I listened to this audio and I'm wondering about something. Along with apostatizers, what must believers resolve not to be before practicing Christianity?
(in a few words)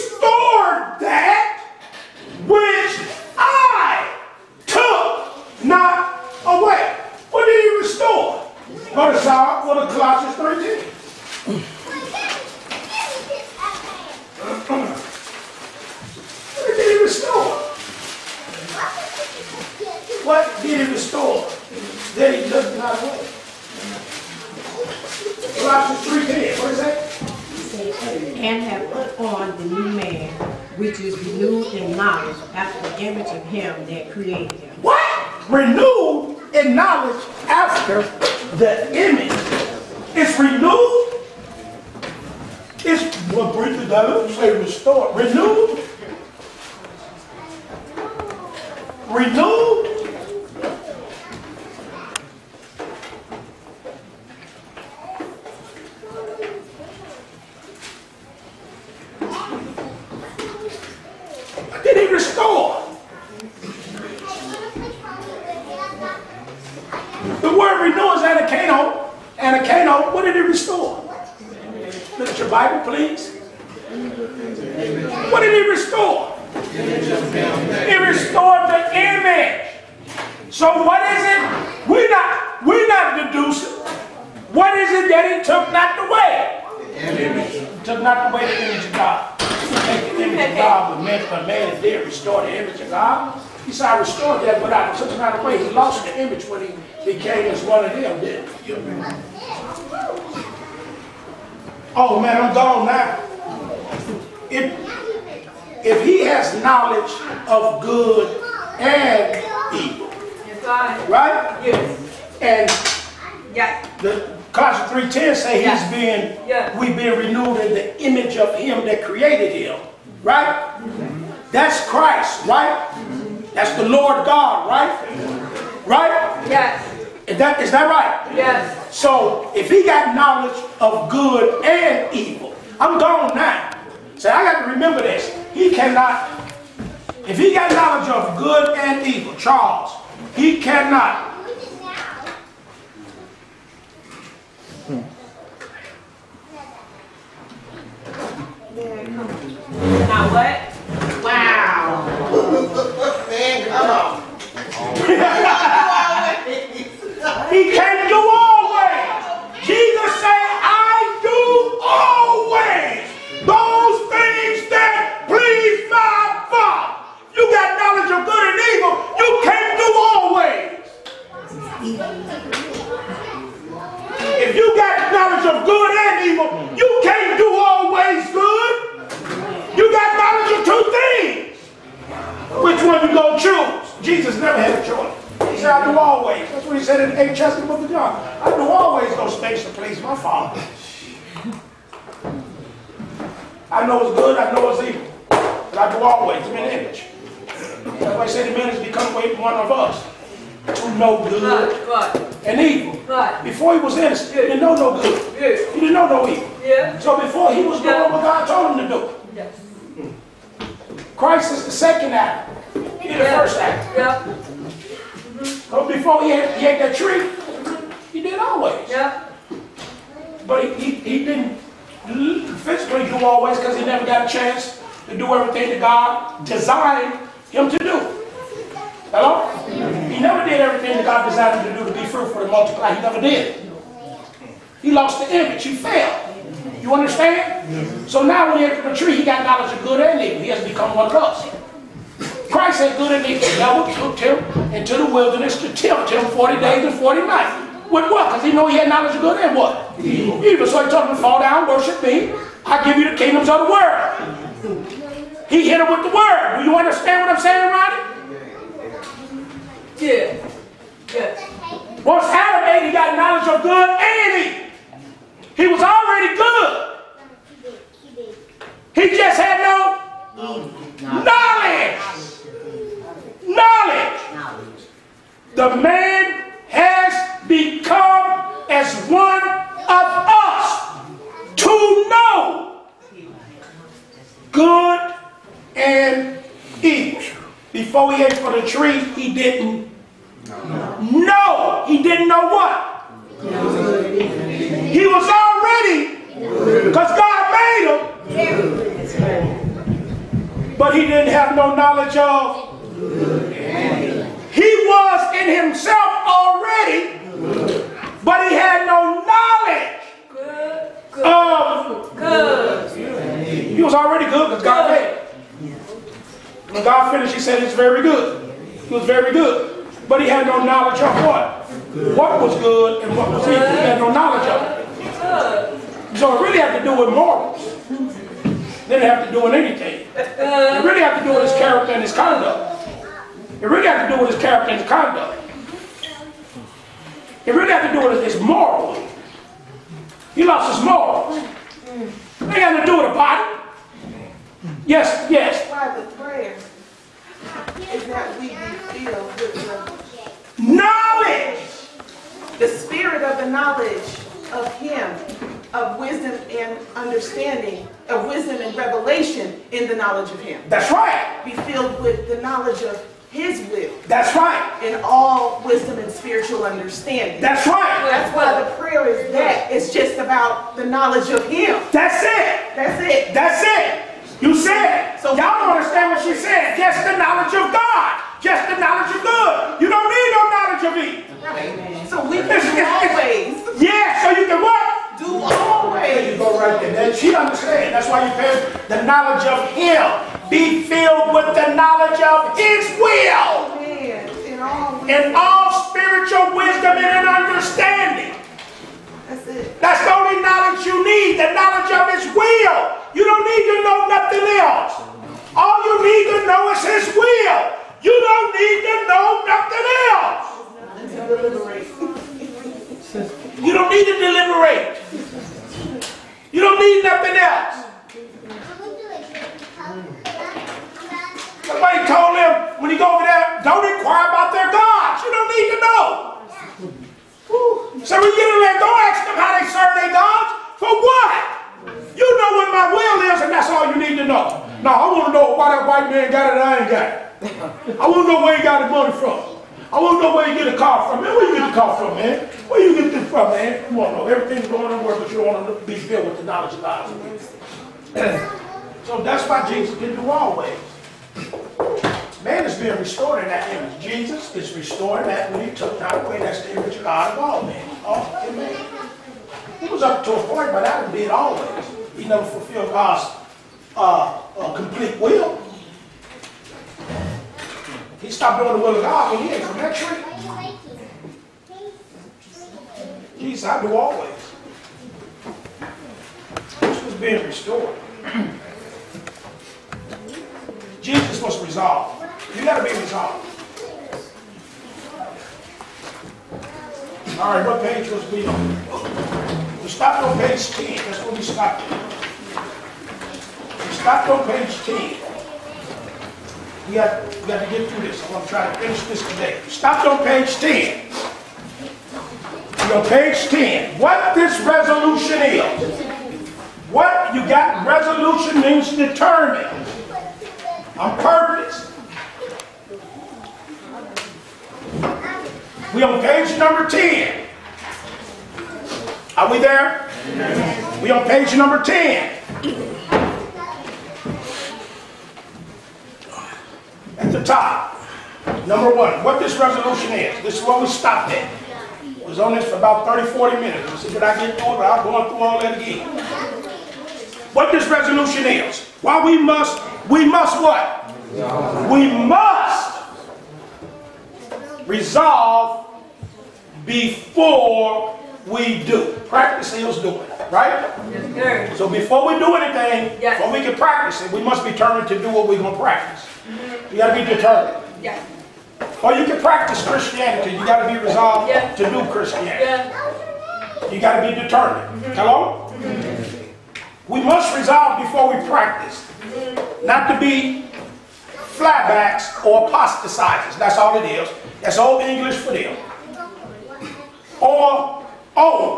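Flatbacks.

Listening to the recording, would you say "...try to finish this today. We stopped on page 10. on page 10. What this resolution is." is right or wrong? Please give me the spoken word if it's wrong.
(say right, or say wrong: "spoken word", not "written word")
right.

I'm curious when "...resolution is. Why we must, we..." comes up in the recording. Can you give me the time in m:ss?
8:57.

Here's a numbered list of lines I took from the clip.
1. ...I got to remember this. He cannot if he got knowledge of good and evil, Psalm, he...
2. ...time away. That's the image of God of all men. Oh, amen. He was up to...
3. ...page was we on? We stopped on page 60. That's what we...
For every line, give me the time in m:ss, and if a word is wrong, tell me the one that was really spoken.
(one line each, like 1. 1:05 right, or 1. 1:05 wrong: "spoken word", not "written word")
1. 2:14 wrong: "Charles", not "Psalm"
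2. 7:35 right
3. 8:07 wrong: "10", not "60".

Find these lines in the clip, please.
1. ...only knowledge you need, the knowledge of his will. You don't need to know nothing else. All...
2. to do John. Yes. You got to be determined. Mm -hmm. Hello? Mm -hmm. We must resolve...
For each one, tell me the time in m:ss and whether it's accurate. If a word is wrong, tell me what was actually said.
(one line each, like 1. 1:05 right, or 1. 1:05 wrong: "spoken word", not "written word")
1. 6:40 right
2. 9:21 wrong: "Christianity", not "John".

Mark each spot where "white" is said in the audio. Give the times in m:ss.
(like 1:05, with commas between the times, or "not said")
7:15.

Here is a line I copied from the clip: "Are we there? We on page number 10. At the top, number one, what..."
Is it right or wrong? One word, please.
right.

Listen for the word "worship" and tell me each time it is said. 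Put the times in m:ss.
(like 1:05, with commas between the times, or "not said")
4:11.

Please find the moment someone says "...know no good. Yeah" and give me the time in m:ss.
3:24.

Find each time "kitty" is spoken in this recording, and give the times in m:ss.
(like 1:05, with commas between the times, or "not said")
not said.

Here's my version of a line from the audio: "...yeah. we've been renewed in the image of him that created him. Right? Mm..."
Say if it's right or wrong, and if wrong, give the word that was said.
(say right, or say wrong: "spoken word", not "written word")
right.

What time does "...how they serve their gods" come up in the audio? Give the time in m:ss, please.
7:09.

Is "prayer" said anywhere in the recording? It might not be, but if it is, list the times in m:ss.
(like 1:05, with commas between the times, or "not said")
5:46, 6:08.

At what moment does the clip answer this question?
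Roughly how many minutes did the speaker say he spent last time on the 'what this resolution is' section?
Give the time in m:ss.
8:53.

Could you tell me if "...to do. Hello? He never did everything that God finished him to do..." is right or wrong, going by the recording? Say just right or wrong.
wrong.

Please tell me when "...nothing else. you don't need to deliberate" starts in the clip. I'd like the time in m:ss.
6:49.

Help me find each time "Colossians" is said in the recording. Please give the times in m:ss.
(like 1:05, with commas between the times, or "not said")
0:09, 0:25, 1:54.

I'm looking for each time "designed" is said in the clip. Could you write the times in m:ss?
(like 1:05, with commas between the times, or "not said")
3:46, 3:51.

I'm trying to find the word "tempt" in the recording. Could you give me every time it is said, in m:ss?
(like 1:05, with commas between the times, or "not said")
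4:05.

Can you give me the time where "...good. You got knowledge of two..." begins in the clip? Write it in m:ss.
2:58.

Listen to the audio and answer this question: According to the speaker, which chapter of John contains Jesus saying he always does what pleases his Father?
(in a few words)
8th chapter.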